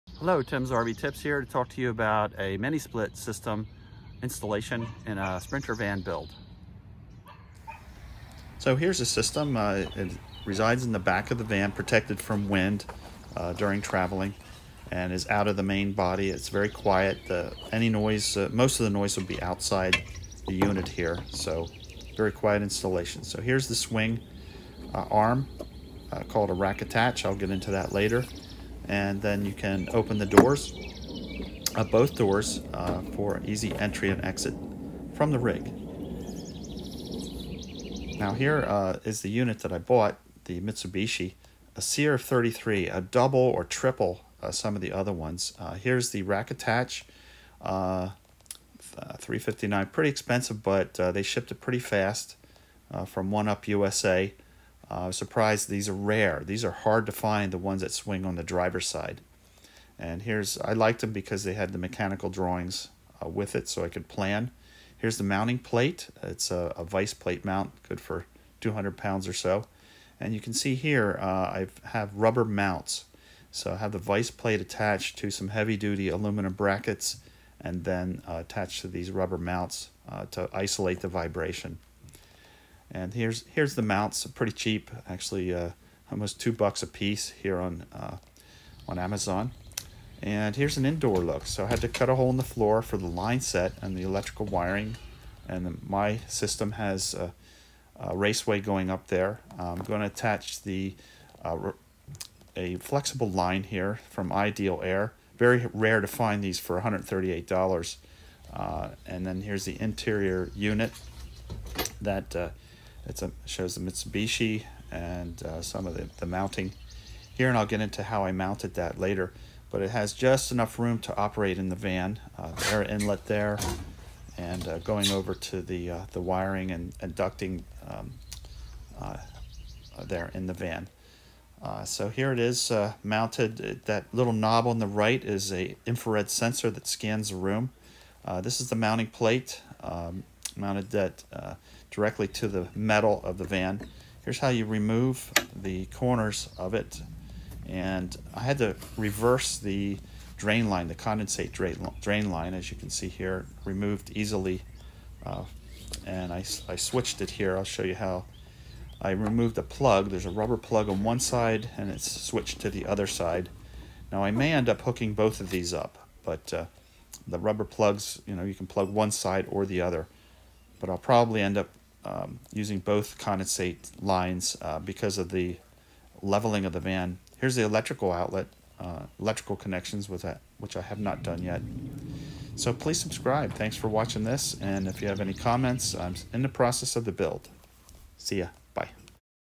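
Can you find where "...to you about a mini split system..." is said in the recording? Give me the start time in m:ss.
0:01.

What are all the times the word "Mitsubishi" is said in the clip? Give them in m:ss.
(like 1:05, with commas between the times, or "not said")
0:40, 1:53.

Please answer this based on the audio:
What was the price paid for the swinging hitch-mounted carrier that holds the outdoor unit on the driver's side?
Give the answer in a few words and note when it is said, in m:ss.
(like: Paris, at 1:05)
$359, at 0:48.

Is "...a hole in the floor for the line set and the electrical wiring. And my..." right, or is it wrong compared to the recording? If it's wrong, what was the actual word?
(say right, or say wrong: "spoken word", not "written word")
right.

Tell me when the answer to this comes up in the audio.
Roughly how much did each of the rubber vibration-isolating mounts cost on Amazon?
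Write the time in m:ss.
1:26.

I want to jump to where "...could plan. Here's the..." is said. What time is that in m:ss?
1:03.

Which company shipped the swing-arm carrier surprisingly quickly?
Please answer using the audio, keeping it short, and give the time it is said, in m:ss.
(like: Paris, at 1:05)
1Up USA, at 0:53.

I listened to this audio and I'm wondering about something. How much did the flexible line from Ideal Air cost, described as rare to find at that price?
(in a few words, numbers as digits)
$138.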